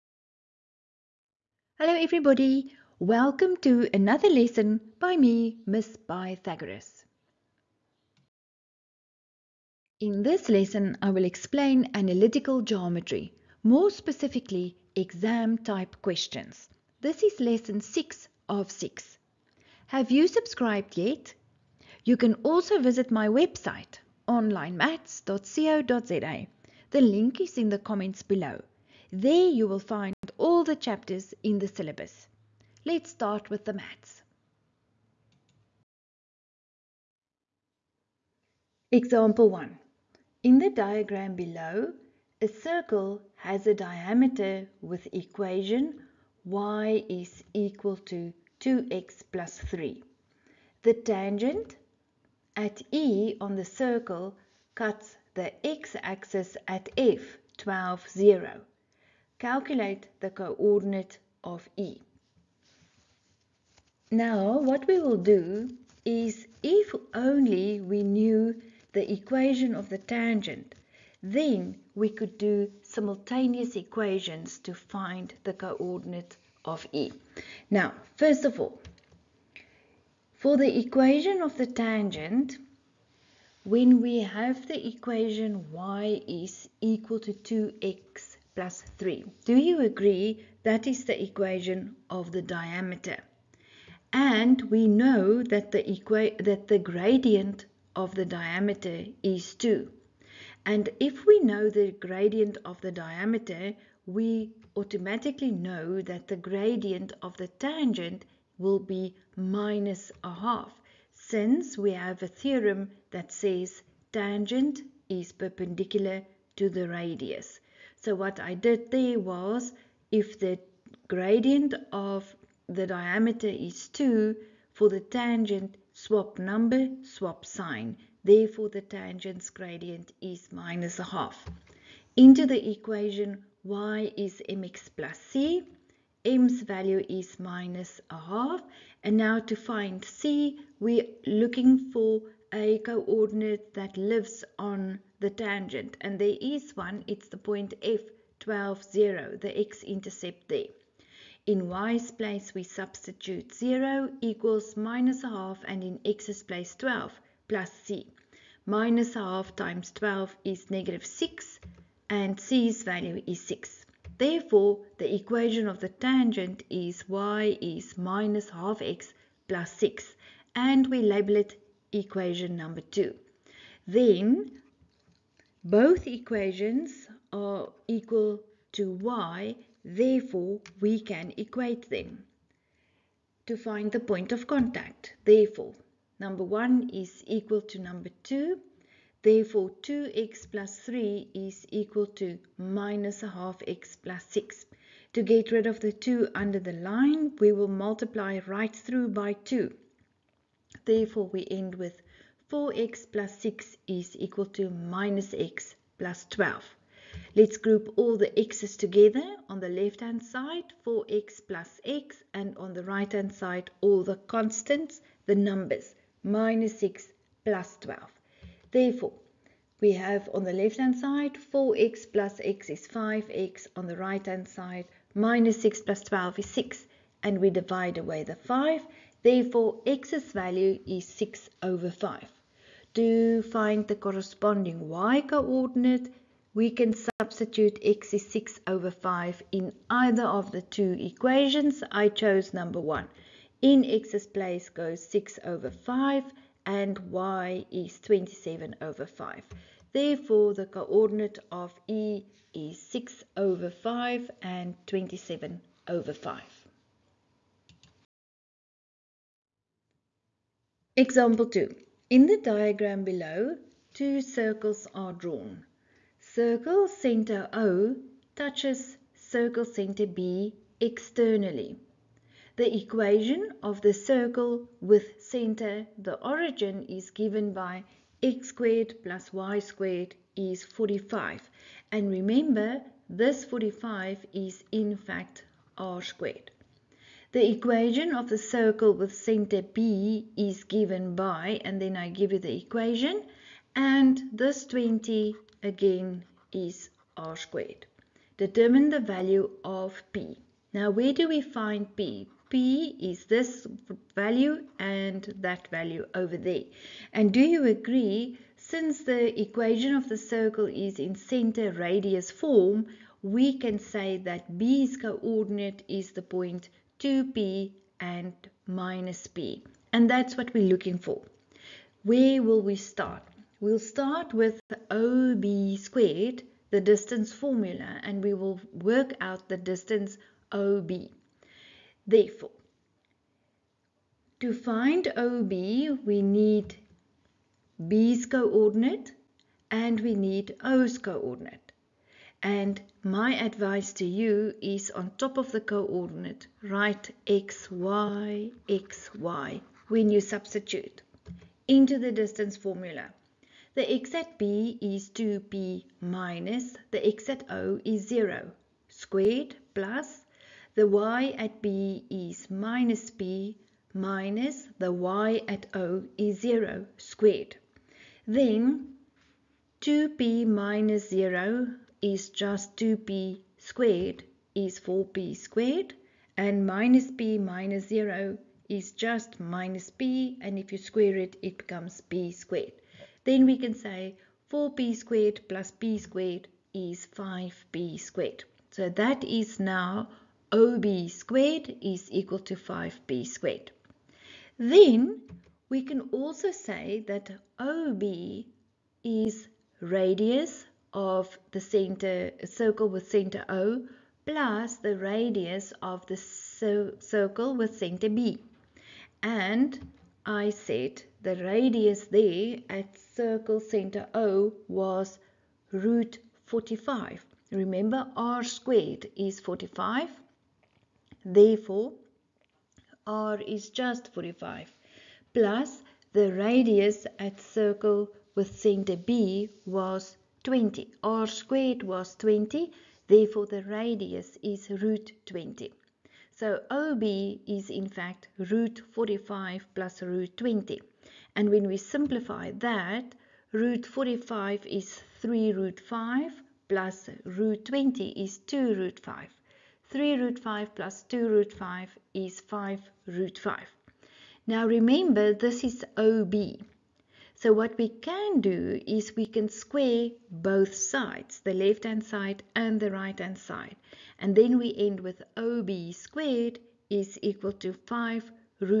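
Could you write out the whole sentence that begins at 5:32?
Therefore, to find OB, we need B's coordinate and we need O's coordinate.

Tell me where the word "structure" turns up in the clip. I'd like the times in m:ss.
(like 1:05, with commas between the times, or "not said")
not said.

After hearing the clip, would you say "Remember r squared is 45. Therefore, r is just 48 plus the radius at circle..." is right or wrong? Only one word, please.
wrong.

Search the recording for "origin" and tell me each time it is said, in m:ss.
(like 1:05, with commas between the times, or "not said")
4:36.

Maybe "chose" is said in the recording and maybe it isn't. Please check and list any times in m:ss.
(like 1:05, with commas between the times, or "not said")
4:02.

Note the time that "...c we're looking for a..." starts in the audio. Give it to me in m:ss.
2:20.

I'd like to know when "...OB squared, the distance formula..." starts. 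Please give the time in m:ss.
5:24.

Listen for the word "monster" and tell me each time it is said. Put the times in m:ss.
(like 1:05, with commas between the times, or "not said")
not said.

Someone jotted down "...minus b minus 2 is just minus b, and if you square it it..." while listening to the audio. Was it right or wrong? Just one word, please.
wrong.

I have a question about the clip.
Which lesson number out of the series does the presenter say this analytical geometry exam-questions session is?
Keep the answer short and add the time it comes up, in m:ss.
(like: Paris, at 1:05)
6, at 0:17.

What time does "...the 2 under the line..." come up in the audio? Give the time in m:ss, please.
3:15.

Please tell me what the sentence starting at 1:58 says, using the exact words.
So what I did there was if the gradient of the diameter is 2, for the tangent swap number, swap sign.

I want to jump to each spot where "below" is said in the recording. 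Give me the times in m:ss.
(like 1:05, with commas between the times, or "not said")
0:28, 0:41, 4:23.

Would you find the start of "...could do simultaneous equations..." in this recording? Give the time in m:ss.
1:12.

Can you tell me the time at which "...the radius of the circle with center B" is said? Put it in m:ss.
6:44.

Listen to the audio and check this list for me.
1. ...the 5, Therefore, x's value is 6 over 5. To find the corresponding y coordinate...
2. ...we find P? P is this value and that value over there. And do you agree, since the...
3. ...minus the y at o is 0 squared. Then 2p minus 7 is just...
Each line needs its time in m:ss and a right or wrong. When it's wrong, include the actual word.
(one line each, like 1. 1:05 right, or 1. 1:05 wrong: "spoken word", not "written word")
1. 3:48 right
2. 5:01 right
3. 6:03 wrong: "0", not "7".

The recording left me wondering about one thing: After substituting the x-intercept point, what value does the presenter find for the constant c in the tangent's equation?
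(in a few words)
6.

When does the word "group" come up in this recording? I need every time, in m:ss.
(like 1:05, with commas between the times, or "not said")
3:27.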